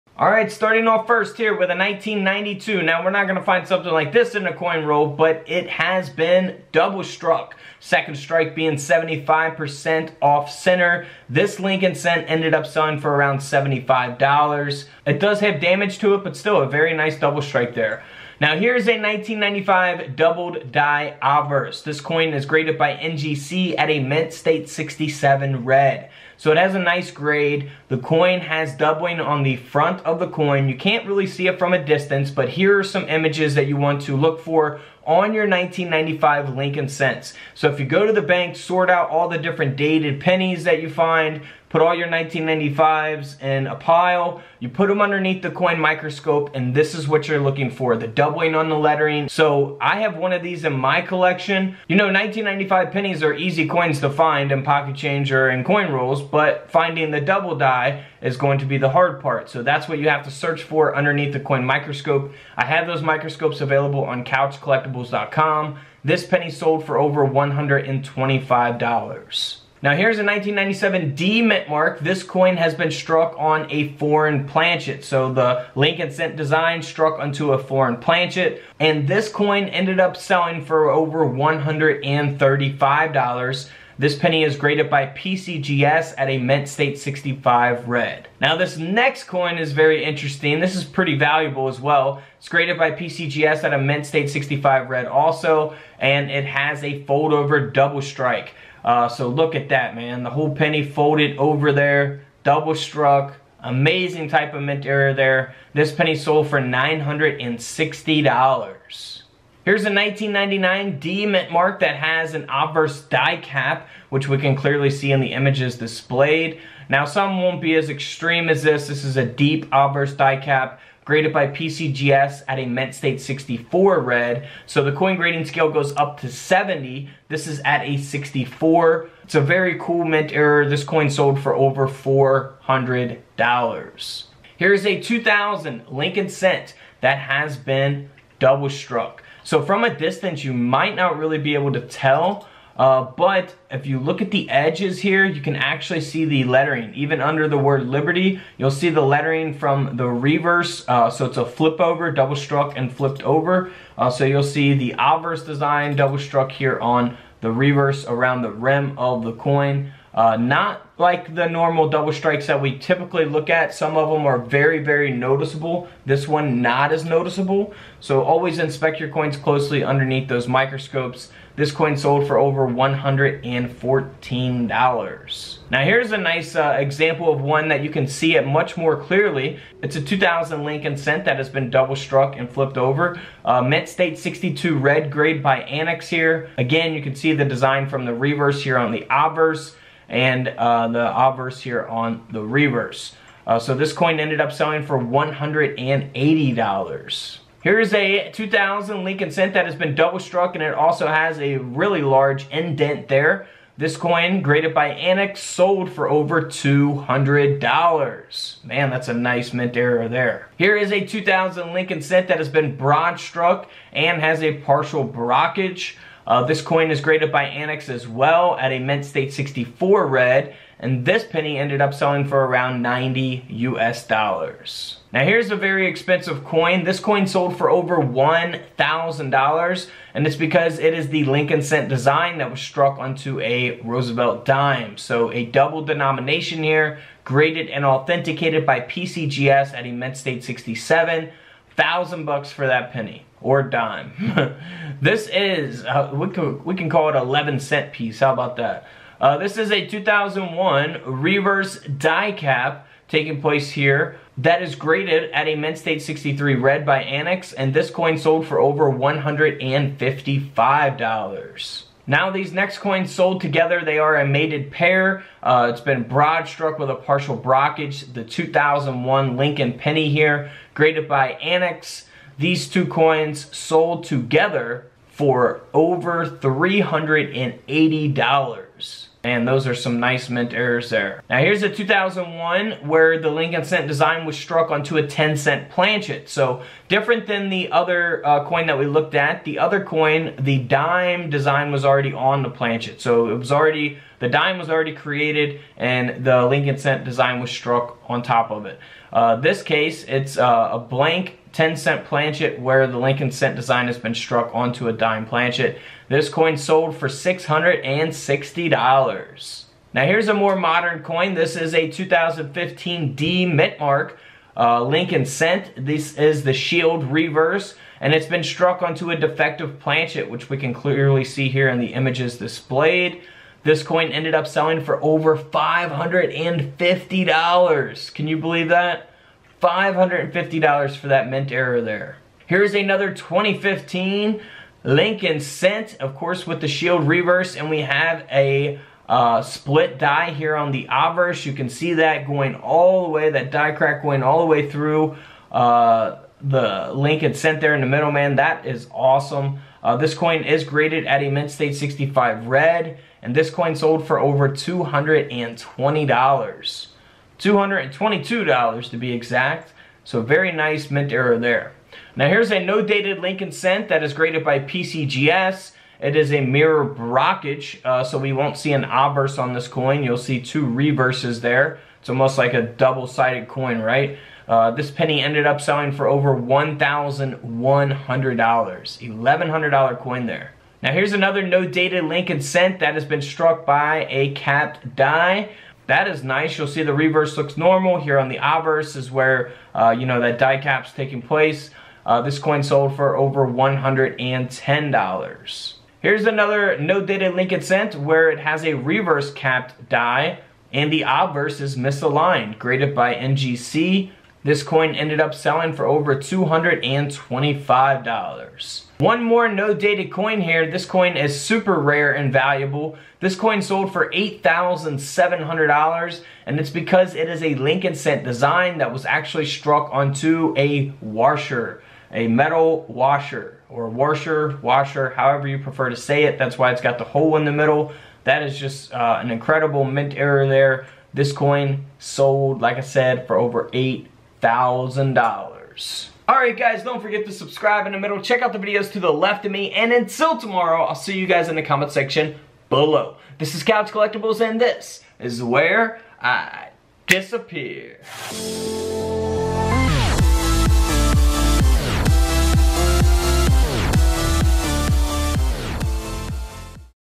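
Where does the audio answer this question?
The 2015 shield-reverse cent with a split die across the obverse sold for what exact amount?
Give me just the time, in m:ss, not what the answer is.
5:57.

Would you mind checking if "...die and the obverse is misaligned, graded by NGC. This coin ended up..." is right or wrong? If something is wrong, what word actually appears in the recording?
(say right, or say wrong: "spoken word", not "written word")
right.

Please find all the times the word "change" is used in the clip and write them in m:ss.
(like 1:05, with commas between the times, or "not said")
0:54.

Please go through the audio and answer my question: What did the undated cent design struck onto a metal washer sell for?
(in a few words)
$8,700.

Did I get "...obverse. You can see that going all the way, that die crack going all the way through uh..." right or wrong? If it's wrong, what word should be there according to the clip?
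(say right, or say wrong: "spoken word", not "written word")
right.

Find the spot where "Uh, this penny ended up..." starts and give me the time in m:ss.
6:14.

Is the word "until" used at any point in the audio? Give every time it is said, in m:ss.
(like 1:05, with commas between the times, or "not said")
7:19.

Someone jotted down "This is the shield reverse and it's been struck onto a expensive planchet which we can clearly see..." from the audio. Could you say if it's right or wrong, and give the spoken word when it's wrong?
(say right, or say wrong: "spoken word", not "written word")
wrong: "defective", not "expensive".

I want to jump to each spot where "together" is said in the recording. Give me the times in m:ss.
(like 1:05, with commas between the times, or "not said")
4:23, 4:34.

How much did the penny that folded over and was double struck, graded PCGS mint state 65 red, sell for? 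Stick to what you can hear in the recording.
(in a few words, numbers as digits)
$960.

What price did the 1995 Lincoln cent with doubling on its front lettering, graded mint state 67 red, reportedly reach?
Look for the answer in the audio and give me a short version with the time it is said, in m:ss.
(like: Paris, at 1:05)
$125, at 1:06.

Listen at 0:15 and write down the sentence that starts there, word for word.
It does have damage to it, but still a very nice double strike there.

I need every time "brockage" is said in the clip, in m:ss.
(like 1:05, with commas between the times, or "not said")
3:35, 4:27, 6:06.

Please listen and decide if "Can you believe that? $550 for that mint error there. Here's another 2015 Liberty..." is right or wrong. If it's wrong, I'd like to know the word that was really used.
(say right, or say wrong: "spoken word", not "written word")
wrong: "Lincoln", not "Liberty".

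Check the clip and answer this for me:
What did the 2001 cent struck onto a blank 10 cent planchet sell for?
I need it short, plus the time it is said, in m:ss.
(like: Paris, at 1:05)
$660, at 5:07.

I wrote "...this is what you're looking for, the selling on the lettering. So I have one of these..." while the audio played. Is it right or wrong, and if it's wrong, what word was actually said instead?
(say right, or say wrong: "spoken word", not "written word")
wrong: "doubling", not "selling".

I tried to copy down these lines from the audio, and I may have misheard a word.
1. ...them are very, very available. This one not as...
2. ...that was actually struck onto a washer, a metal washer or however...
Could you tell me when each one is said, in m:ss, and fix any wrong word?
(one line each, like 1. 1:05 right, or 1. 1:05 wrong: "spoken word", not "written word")
1. 2:44 wrong: "noticeable", not "available"
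2. 6:58 wrong: "washer", not "however".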